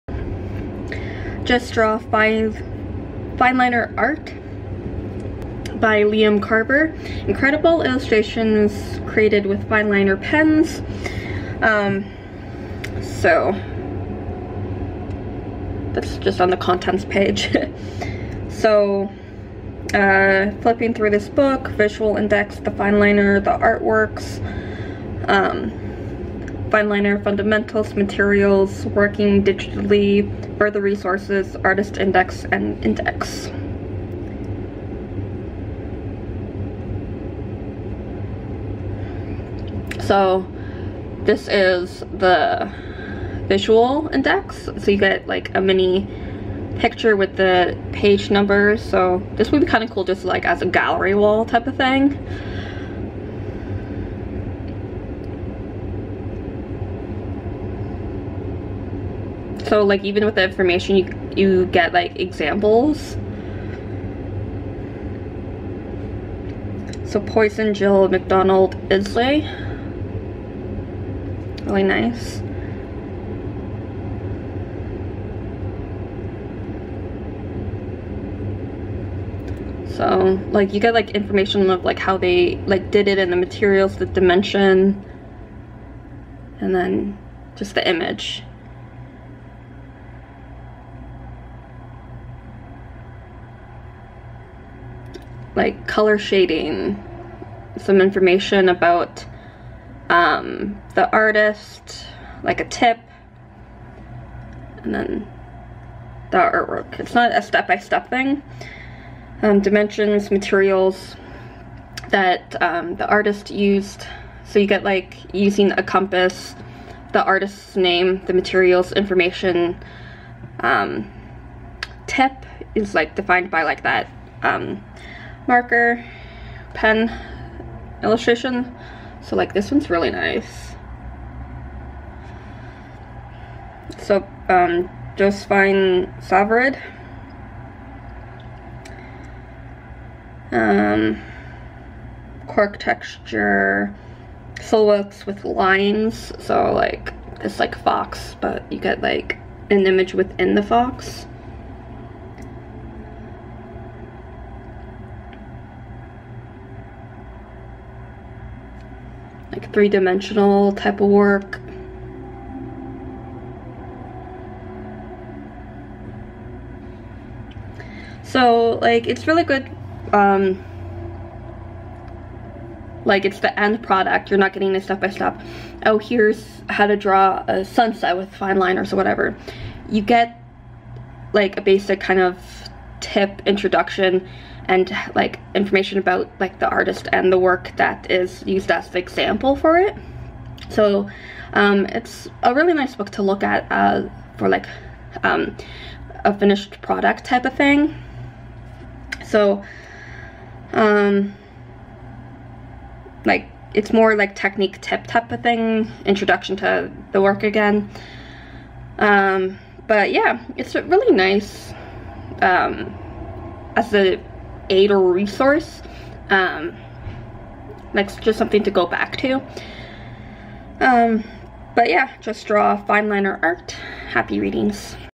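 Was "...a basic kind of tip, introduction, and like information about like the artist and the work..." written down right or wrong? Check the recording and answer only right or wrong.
right.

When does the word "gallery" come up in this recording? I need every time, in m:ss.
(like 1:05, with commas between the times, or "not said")
0:50.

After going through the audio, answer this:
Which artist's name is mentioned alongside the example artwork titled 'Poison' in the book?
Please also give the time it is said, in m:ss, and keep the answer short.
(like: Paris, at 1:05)
Jill McDonald, at 1:07.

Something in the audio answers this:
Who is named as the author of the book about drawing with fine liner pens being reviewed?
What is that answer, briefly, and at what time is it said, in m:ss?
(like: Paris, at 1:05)
Liam Carver, at 0:06.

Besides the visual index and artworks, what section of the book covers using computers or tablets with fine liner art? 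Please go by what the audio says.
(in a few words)
Working digitally.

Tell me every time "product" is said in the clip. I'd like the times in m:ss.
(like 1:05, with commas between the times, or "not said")
2:53, 3:16.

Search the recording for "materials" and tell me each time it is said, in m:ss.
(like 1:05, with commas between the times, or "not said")
0:27, 1:23, 1:50, 1:58.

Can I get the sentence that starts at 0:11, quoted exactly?
Um, so that's just on the contents page.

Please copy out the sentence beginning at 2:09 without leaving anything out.
So like this one's really nice.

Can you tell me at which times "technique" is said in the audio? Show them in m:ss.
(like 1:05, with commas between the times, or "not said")
3:24.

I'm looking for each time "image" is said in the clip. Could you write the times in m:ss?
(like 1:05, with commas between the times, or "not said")
1:27, 2:29.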